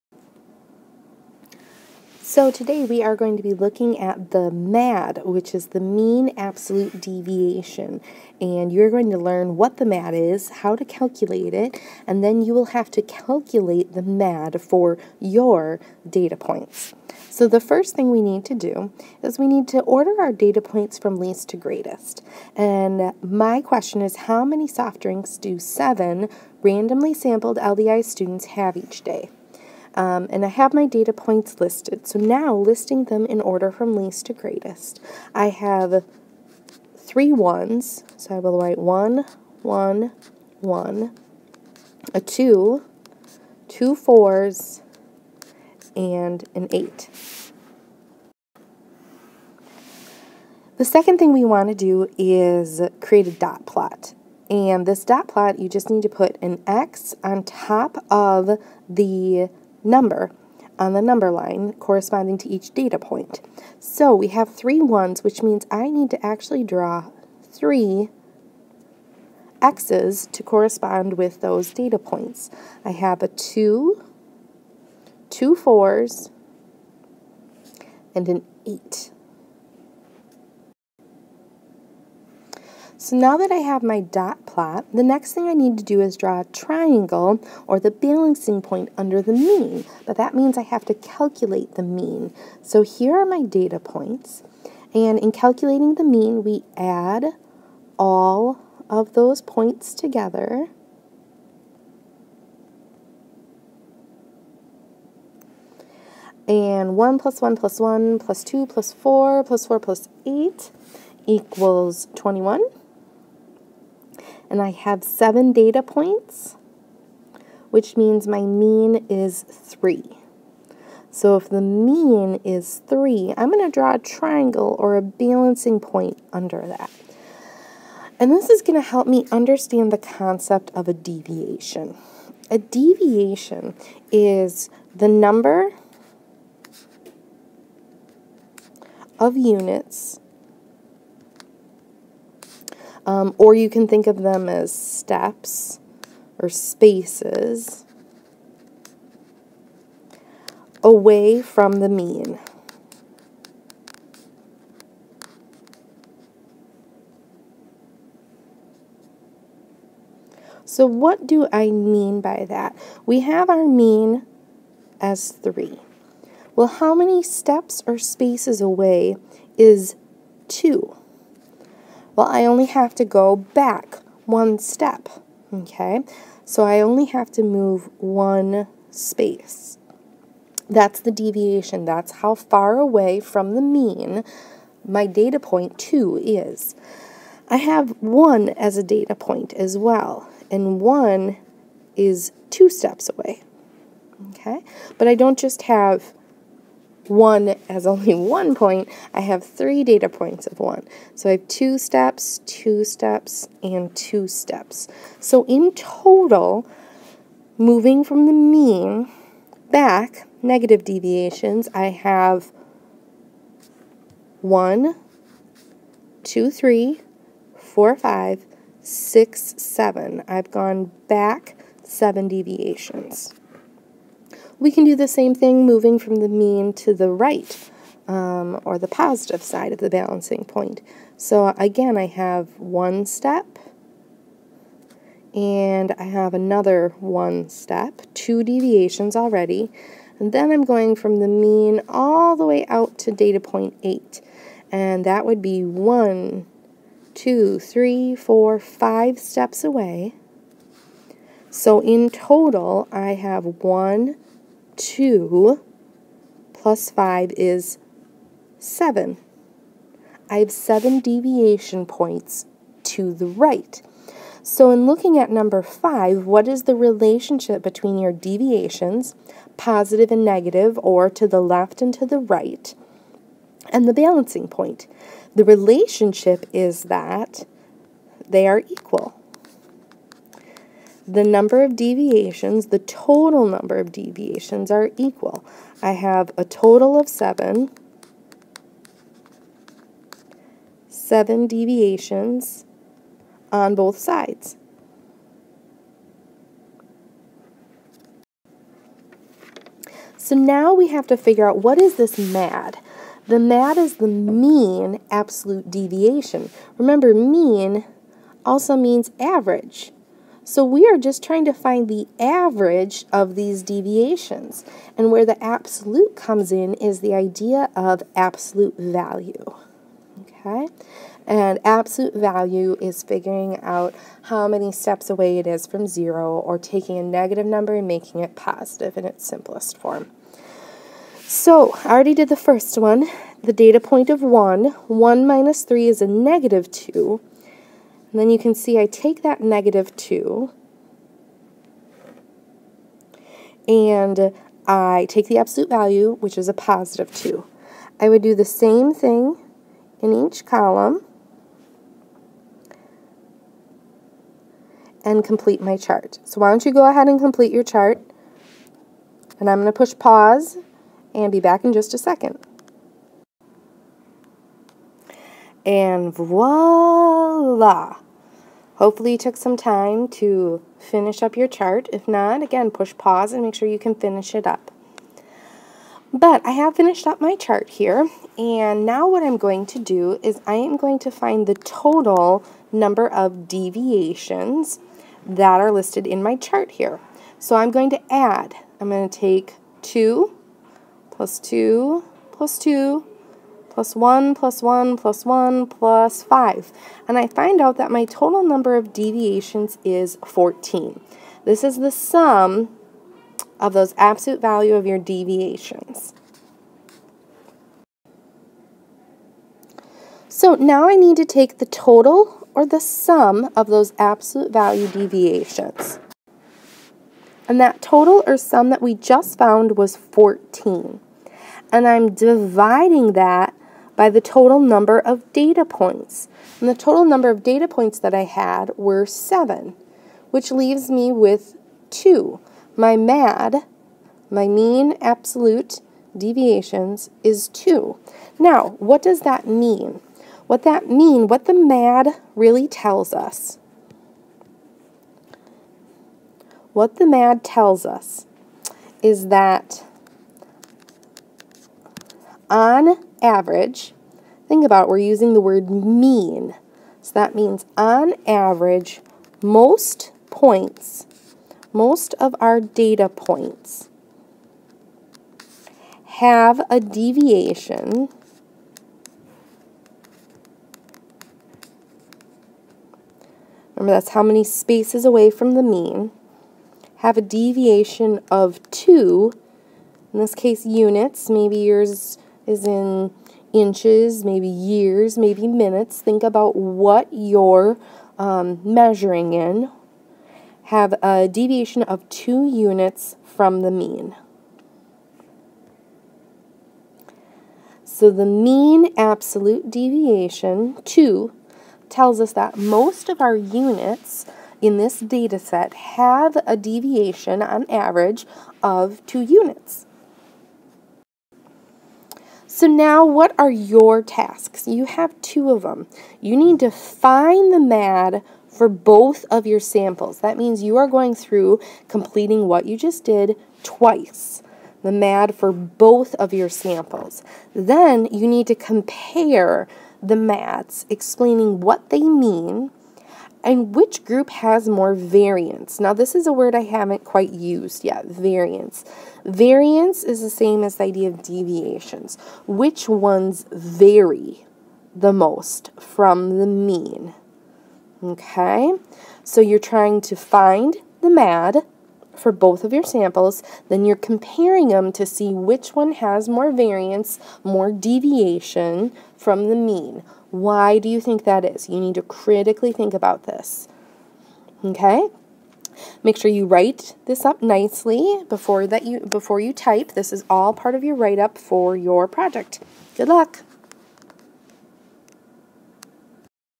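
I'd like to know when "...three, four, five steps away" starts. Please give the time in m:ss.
4:07.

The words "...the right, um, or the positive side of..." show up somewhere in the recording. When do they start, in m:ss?
3:46.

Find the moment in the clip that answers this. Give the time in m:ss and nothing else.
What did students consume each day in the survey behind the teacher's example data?
0:24.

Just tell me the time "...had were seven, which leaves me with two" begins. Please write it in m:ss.
7:08.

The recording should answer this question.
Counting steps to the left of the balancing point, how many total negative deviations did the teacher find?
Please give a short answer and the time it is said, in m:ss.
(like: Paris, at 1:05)
7, at 3:41.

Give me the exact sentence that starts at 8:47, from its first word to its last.
Then you need to compare the MADs, explaining what they mean, and which group has more variance?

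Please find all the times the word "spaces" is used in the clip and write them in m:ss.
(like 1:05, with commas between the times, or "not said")
2:26, 2:47, 2:58, 7:54.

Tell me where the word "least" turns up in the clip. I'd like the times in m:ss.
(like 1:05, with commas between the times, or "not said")
0:21, 0:33.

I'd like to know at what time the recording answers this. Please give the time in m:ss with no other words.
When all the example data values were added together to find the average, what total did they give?
1:51.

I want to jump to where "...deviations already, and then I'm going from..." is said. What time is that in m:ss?
3:58.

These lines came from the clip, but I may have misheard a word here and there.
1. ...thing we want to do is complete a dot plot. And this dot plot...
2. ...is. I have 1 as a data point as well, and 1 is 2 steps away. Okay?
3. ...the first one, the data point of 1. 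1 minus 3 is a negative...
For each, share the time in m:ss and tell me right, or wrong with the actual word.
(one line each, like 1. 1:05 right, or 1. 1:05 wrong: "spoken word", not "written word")
1. 0:51 wrong: "create", not "complete"
2. 3:06 right
3. 5:32 right.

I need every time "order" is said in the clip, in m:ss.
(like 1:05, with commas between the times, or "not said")
0:19, 0:33.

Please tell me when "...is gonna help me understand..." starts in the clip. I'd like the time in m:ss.
2:08.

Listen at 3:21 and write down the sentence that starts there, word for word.
So I have two steps, two steps, and two steps.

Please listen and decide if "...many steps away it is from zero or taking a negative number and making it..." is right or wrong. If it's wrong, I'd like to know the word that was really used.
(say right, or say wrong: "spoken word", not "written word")
right.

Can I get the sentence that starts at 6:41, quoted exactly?
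This is the sum of those absolute value of your deviations.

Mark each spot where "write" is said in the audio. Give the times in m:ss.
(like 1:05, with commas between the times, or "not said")
0:38, 9:26, 9:30.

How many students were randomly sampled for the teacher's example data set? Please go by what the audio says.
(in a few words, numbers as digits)
7.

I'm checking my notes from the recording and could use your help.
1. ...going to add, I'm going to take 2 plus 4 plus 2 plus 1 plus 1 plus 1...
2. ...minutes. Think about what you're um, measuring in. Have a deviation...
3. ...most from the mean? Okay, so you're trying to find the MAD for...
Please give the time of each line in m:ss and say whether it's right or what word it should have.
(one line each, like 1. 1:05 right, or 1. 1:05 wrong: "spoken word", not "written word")
1. 6:27 wrong: "2", not "4"
2. 8:05 right
3. 9:05 right.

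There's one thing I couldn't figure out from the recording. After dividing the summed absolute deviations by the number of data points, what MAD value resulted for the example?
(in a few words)
2.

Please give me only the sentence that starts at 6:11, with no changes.
If not, again, push pause and make sure you can finish it up.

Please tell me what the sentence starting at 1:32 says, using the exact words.
So here are my data points, and in calculating the mean, we add all of those points together.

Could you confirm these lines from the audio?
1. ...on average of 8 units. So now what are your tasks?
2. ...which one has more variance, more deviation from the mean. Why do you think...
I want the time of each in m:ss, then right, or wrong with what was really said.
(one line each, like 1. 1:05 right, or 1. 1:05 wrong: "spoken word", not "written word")
1. 8:27 wrong: "2", not "8"
2. 9:15 right.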